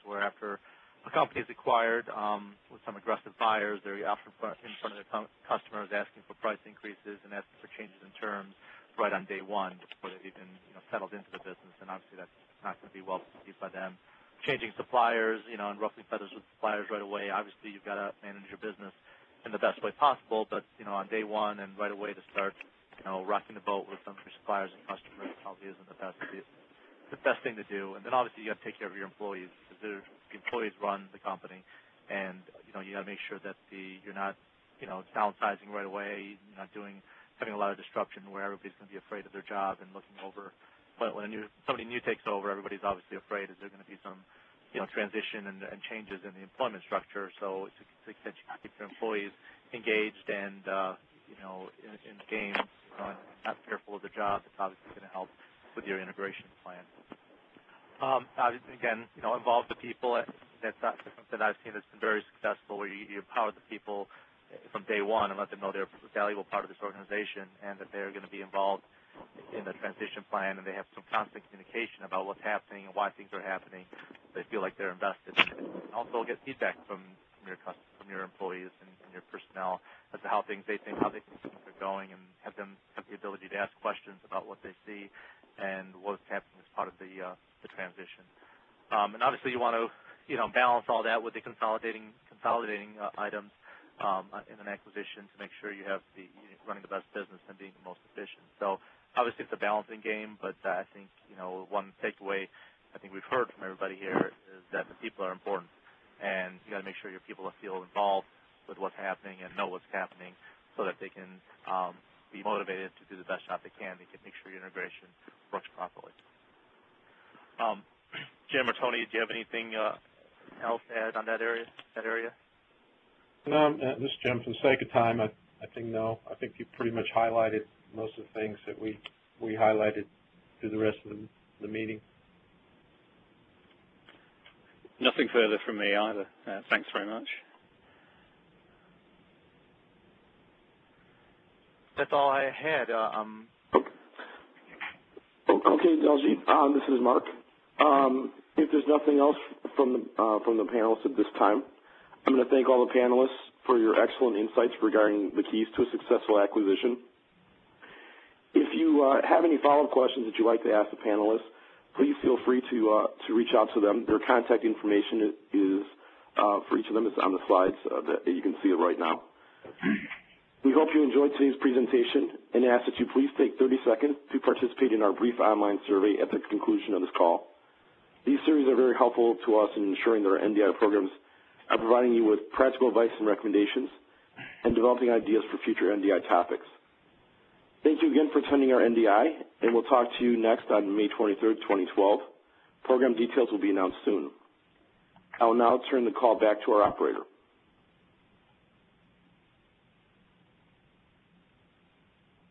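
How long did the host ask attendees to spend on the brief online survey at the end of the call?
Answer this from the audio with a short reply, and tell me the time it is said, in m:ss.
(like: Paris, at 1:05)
30 seconds, at 2:53.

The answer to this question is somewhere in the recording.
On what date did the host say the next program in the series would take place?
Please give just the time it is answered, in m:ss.
3:10.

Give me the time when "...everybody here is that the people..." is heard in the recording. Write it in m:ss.
1:43.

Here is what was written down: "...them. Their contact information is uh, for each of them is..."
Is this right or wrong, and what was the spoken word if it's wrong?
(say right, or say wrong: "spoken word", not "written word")
right.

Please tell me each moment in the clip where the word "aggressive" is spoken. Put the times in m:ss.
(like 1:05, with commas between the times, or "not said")
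0:02.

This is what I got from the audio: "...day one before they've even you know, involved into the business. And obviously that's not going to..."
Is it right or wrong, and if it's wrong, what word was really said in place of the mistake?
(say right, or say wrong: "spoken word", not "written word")
wrong: "settled", not "involved".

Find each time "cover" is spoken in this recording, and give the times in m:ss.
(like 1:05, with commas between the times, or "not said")
not said.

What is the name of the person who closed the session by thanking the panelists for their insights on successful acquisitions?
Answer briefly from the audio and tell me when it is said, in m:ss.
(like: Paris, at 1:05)
Mark, at 2:26.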